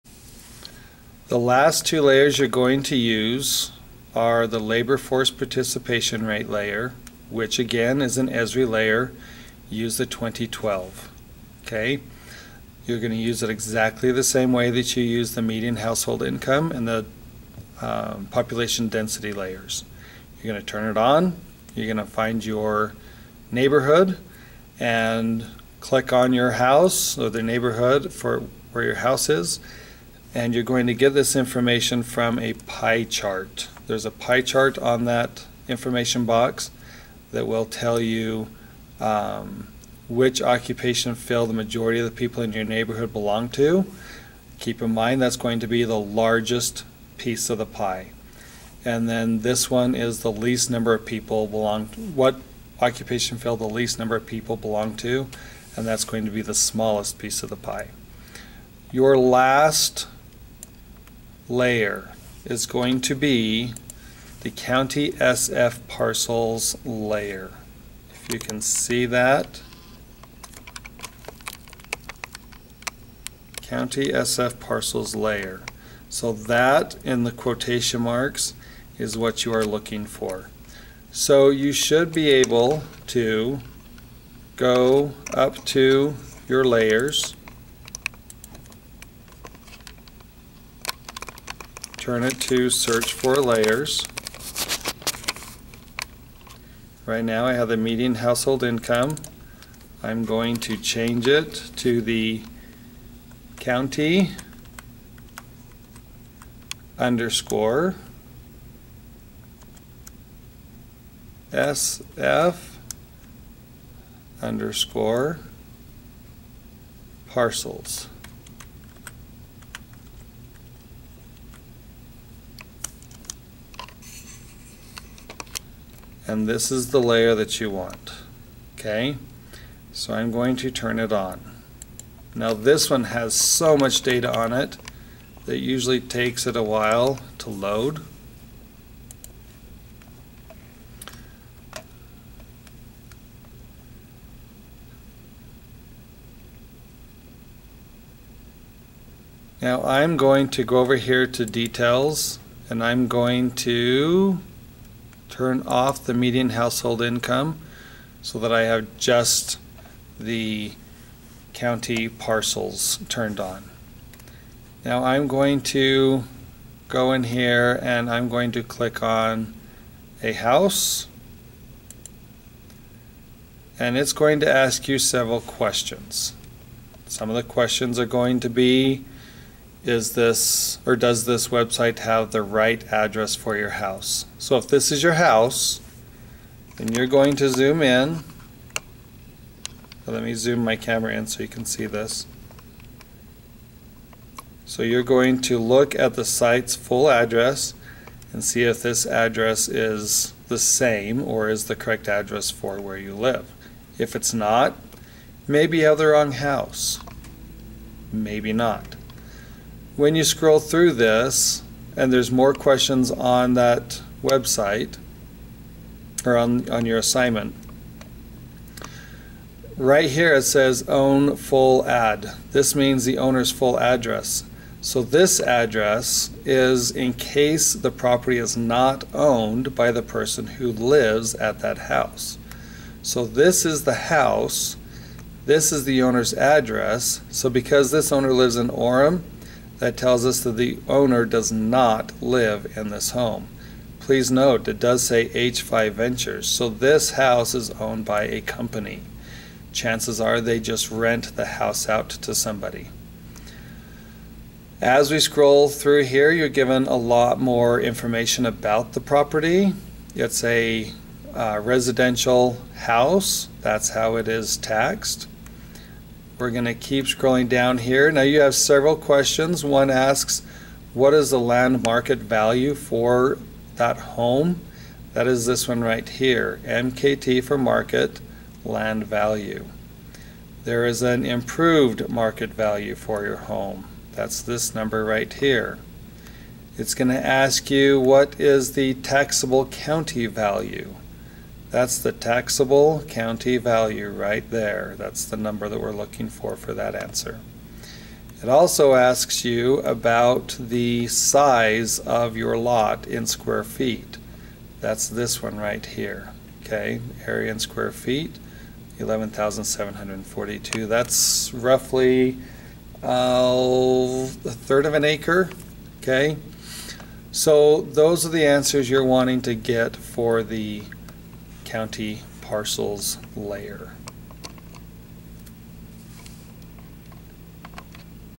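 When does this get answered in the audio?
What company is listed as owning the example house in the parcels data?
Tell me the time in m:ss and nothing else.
4:05.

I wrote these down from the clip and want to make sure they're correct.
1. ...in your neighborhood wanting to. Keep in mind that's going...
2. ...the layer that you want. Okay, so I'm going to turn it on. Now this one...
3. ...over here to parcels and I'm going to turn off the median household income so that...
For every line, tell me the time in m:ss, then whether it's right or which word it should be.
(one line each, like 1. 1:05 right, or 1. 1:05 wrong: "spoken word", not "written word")
1. 0:42 wrong: "belong", not "wanting"
2. 2:06 right
3. 2:30 wrong: "details", not "parcels".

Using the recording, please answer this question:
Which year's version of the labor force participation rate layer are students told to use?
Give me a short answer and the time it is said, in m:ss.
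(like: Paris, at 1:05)
2012, at 0:10.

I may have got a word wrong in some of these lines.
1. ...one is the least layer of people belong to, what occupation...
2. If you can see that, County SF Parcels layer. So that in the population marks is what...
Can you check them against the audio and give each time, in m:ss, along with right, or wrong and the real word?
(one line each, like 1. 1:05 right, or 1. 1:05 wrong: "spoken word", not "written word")
1. 0:49 wrong: "number", not "layer"
2. 1:08 wrong: "quotation", not "population".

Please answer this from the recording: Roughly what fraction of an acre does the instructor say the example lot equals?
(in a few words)
a third.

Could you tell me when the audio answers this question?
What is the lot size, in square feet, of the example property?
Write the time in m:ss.
5:08.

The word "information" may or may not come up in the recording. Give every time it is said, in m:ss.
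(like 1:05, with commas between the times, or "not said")
0:31, 0:35, 4:17.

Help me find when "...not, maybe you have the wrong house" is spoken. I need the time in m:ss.
3:24.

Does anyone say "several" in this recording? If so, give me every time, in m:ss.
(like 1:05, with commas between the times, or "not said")
2:54, 4:28.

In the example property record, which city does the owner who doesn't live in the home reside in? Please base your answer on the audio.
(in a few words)
Orem.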